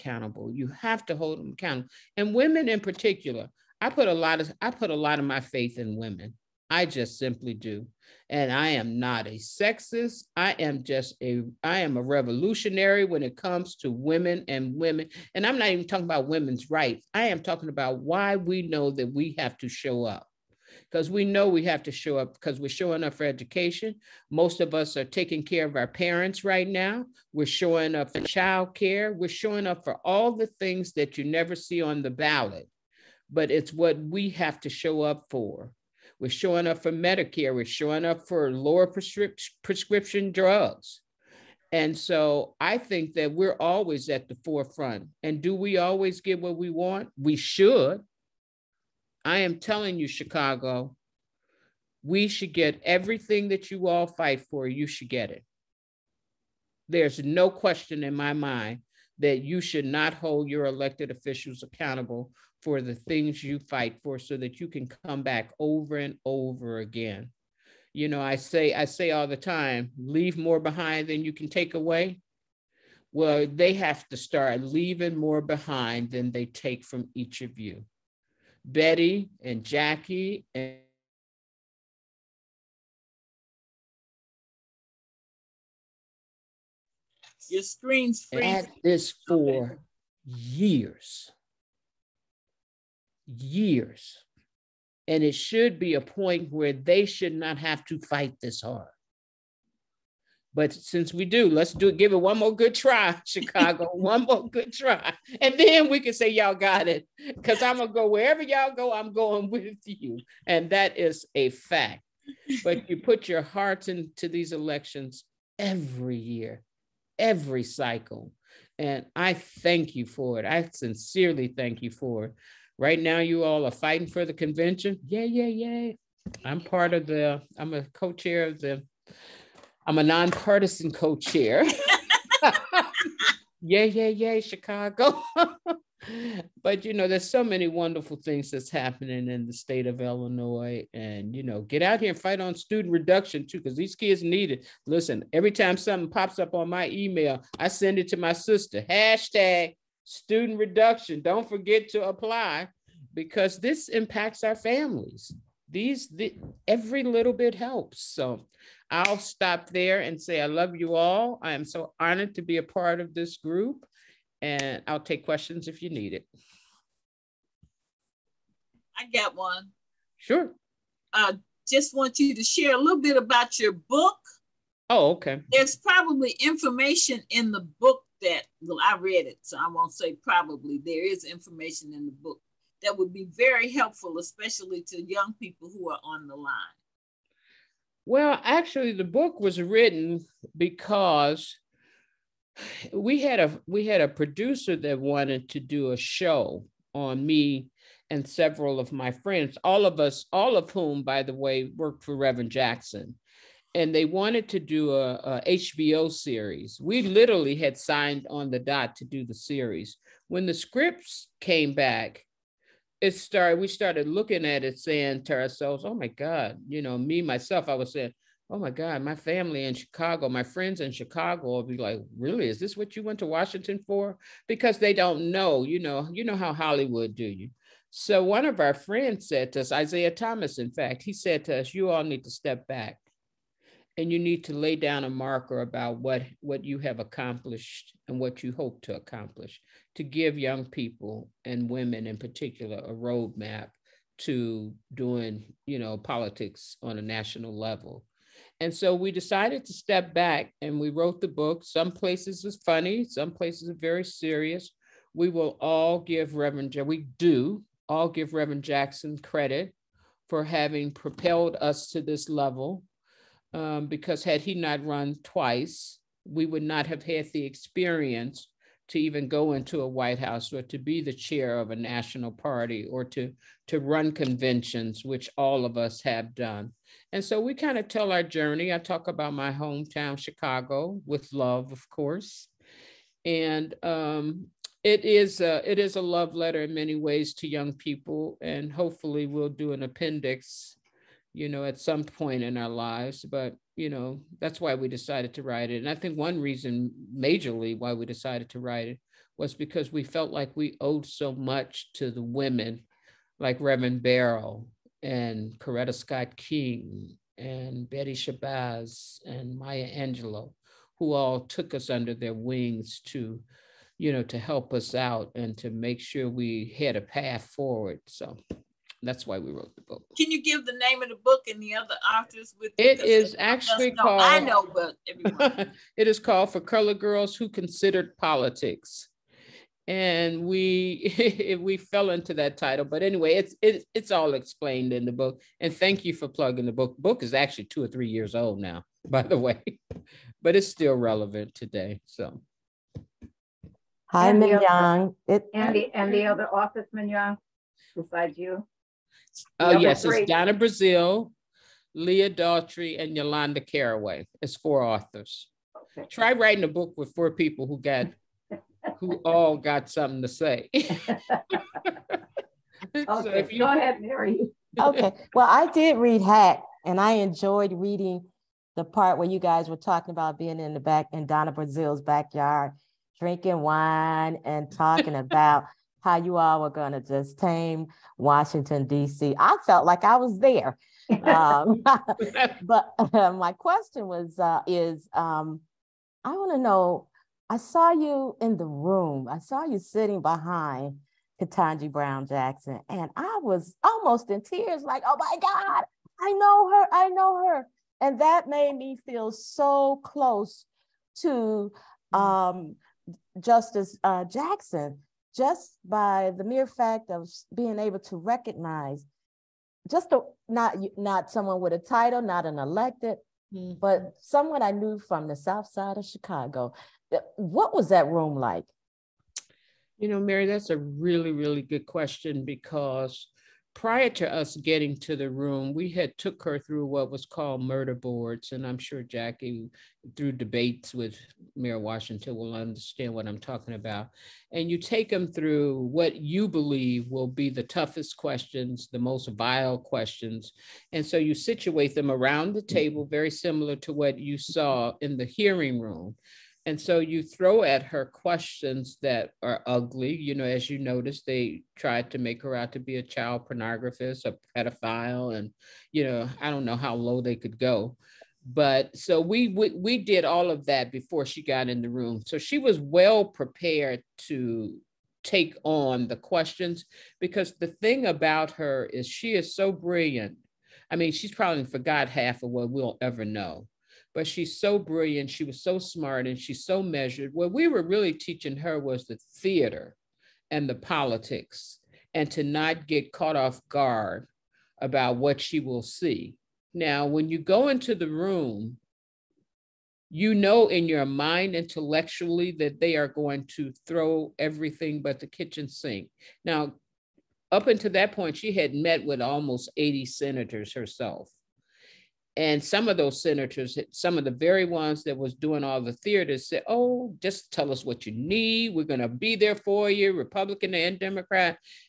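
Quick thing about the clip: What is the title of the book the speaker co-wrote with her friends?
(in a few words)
For Color Girls Who Considered Politics.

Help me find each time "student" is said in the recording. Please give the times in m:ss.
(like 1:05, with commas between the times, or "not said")
2:22, 2:30.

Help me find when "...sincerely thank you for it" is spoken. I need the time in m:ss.
2:00.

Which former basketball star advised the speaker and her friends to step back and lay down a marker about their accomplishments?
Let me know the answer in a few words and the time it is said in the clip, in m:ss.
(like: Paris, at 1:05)
Isaiah Thomas, at 3:49.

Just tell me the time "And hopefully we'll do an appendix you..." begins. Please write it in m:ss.
4:48.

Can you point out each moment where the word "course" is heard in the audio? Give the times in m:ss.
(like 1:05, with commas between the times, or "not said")
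4:41.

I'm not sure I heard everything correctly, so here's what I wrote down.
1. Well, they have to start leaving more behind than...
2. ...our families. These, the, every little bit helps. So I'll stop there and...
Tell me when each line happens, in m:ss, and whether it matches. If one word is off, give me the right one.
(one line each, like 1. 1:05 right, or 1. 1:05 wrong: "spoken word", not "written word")
1. 1:13 right
2. 2:34 right.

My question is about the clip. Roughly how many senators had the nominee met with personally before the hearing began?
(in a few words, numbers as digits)
80.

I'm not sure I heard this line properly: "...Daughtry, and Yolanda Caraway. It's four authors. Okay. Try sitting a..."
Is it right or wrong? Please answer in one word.
wrong.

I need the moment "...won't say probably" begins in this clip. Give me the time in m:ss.
2:59.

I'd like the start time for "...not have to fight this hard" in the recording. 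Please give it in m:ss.
1:37.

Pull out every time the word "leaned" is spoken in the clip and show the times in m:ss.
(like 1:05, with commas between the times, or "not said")
not said.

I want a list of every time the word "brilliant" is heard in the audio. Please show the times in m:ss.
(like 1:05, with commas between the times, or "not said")
7:49, 7:54.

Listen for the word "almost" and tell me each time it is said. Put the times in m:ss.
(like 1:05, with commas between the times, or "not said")
6:33, 8:19.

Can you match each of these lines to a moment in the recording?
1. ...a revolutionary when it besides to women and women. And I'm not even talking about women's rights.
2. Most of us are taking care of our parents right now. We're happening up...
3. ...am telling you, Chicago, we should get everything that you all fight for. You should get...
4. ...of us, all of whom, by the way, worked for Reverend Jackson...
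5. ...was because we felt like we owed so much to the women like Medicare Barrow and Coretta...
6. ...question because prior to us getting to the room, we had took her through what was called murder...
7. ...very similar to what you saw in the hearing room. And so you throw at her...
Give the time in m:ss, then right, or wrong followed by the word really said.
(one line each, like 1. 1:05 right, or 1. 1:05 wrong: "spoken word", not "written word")
1. 0:11 wrong: "comes", not "besides"
2. 0:24 wrong: "showing", not "happening"
3. 0:49 right
4. 3:19 right
5. 4:59 wrong: "Reverend", not "Medicare"
6. 7:01 right
7. 7:23 right.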